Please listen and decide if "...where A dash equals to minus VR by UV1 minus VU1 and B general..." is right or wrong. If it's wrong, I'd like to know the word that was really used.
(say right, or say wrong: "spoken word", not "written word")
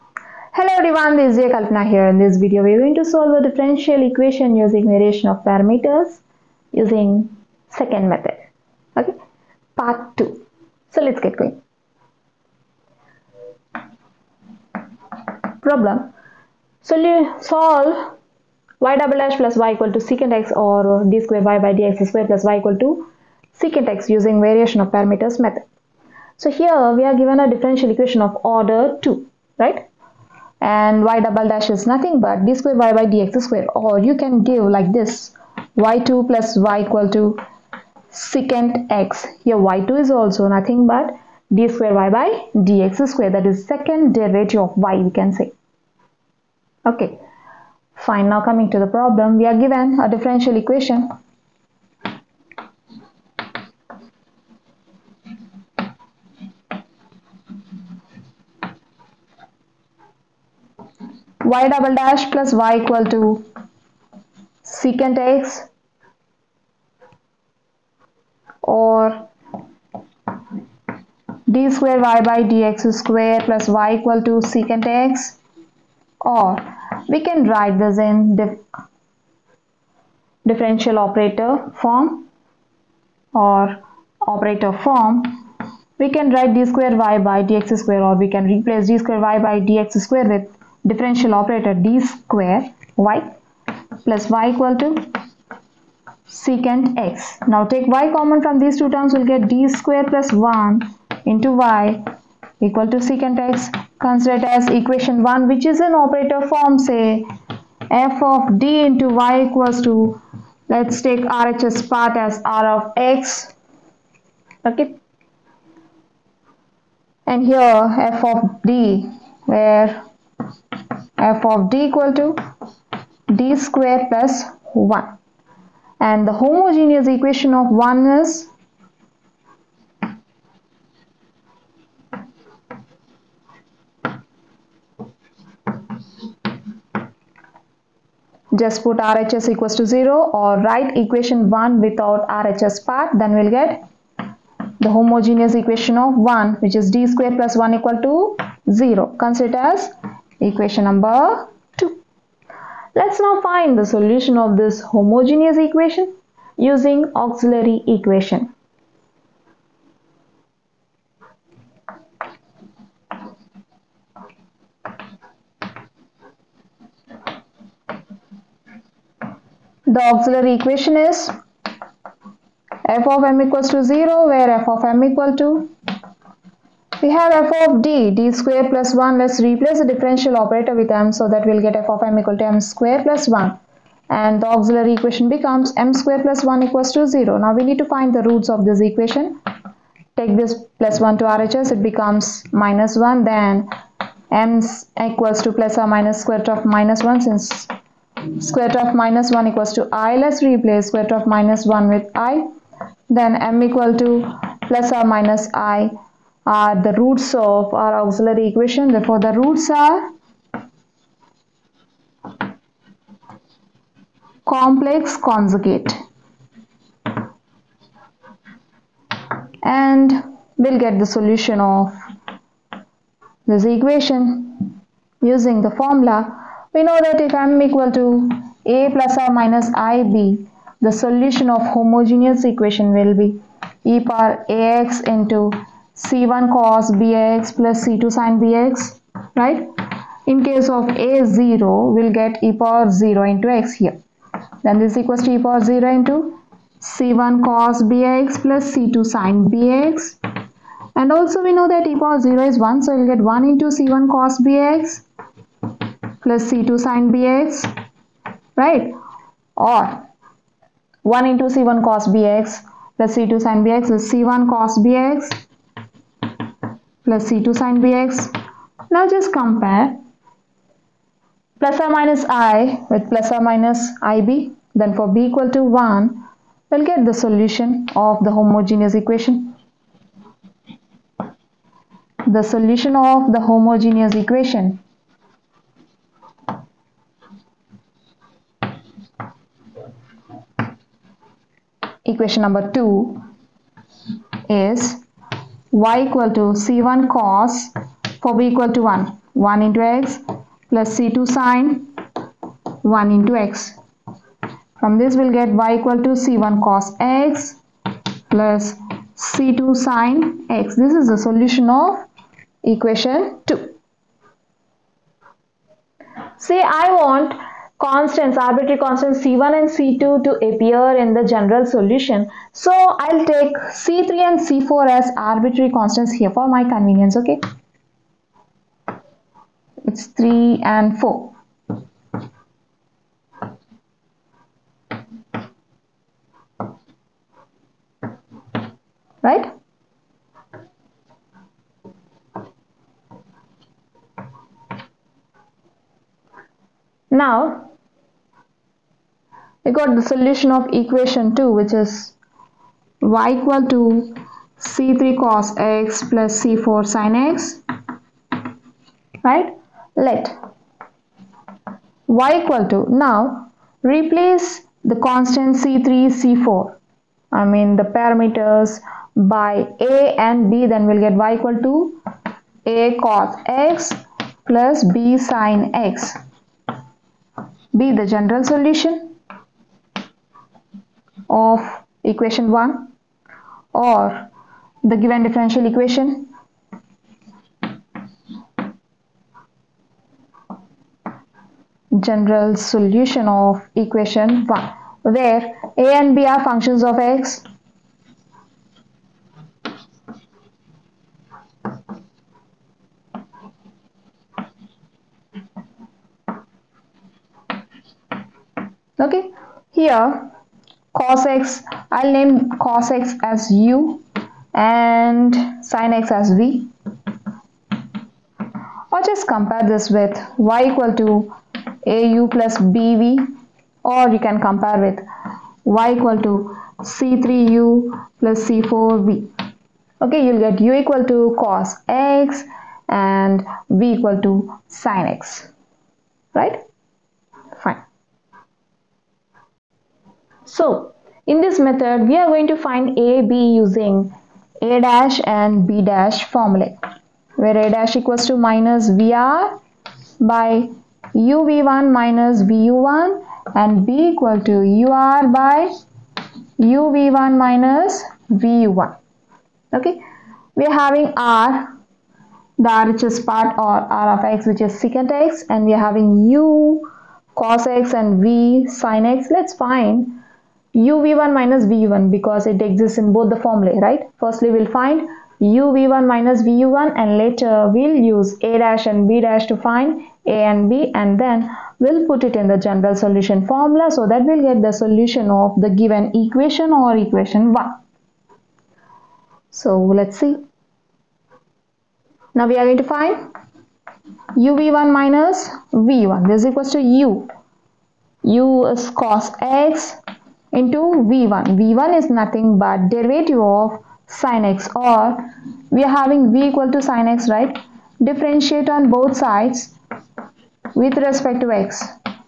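wrong: "equal", not "general".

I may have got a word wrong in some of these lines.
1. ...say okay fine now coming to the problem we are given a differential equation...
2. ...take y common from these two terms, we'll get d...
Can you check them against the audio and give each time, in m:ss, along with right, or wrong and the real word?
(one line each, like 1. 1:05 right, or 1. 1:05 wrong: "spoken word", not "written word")
1. 0:45 right
2. 1:37 right.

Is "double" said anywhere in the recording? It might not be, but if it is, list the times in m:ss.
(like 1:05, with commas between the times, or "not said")
0:18, 0:31, 1:01.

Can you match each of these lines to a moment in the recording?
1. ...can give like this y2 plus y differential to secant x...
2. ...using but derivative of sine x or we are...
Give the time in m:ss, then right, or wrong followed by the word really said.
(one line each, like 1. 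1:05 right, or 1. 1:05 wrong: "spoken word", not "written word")
1. 0:34 wrong: "equal", not "differential"
2. 8:22 wrong: "nothing", not "using".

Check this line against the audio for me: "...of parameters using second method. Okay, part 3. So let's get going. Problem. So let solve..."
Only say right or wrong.
wrong.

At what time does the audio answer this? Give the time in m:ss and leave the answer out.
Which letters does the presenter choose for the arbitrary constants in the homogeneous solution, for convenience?
5:23.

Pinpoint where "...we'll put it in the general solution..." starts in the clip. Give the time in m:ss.
8:01.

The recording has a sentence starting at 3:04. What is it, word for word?
And the auxiliary equation becomes m square plus 1 equals to 0.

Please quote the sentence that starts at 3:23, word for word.
Then m equal to plus or minus i are the roots of our auxiliary equation.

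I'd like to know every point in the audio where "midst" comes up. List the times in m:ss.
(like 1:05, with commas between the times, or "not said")
not said.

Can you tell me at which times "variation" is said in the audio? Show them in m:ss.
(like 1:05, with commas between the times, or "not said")
0:04, 0:24.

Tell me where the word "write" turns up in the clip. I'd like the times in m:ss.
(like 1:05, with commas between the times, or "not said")
1:17, 1:26, 2:20.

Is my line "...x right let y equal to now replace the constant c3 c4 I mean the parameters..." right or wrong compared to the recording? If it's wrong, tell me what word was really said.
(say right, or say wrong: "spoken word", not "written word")
right.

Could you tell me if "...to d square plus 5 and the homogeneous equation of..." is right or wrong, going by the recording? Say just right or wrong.
wrong.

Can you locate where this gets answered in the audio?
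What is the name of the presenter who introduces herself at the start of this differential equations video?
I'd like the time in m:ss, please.
0:01.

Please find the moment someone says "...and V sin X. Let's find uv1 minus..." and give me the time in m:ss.
7:47.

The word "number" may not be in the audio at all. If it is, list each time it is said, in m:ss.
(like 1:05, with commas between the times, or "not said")
2:30, 4:52.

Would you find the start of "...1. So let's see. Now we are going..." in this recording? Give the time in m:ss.
8:07.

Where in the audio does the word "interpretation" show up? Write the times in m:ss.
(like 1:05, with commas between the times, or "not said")
not said.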